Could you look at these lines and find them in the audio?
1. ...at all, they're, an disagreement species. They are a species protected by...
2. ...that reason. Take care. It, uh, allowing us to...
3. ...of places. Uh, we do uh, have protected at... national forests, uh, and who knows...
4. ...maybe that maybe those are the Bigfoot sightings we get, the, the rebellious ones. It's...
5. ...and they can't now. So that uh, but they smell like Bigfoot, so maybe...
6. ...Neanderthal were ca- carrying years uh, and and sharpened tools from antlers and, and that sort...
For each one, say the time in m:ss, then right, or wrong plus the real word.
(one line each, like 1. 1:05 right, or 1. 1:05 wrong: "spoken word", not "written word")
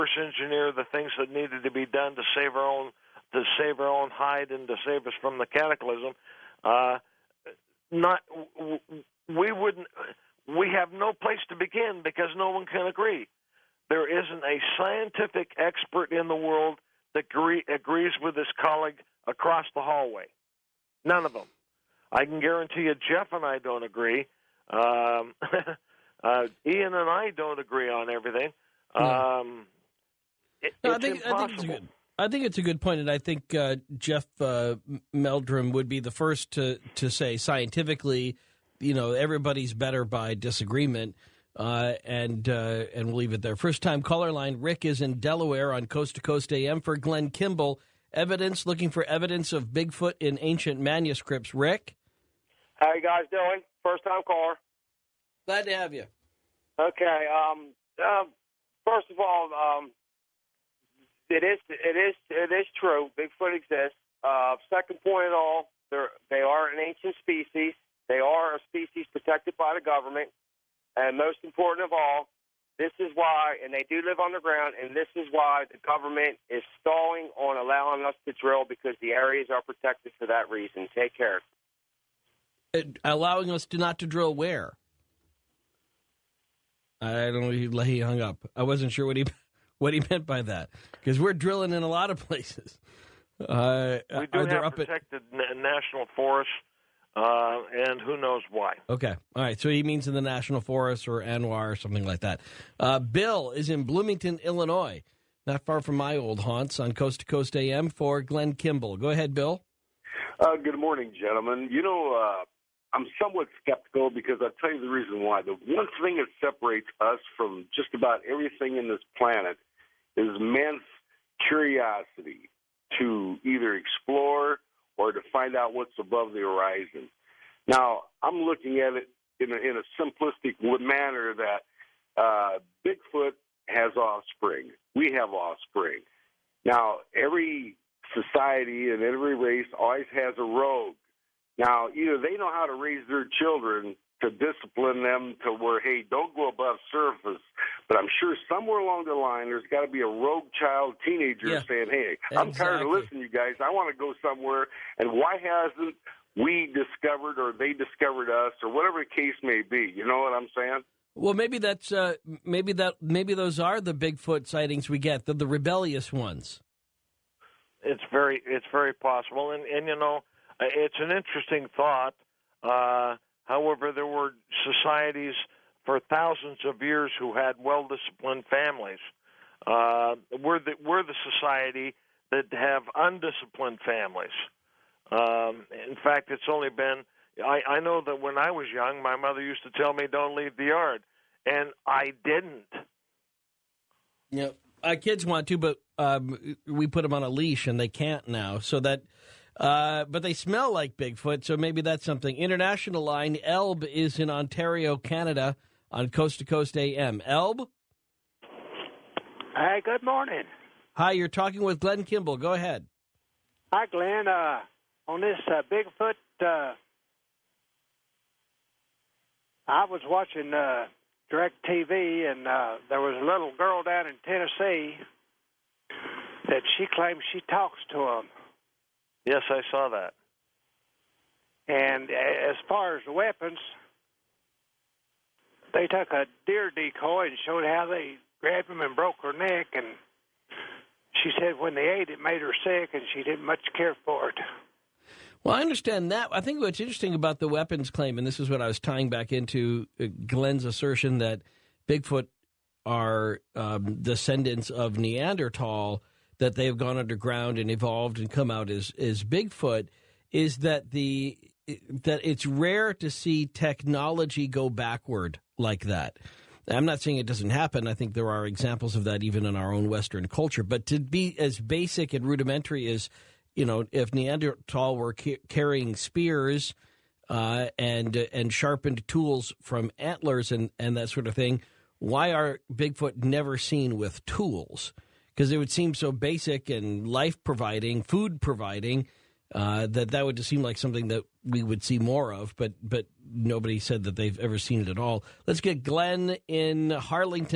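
1. 1:05 wrong: "ancient", not "disagreement"
2. 1:20 right
3. 1:32 right
4. 2:42 right
5. 3:17 right
6. 4:34 wrong: "spears", not "years".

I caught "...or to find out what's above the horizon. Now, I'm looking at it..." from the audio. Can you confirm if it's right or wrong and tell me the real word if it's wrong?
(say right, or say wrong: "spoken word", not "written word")
right.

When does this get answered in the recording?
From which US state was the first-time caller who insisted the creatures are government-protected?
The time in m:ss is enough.
0:45.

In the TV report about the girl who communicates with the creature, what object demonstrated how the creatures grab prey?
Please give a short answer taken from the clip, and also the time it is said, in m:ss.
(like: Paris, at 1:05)
deer decoy, at 3:56.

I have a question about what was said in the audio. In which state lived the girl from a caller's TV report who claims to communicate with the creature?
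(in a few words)
Tennessee.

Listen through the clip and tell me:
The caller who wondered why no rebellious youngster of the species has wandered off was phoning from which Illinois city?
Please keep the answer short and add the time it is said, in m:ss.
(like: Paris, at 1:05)
Bloomington, at 1:43.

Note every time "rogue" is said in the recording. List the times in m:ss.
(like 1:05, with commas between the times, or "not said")
2:20, 2:30.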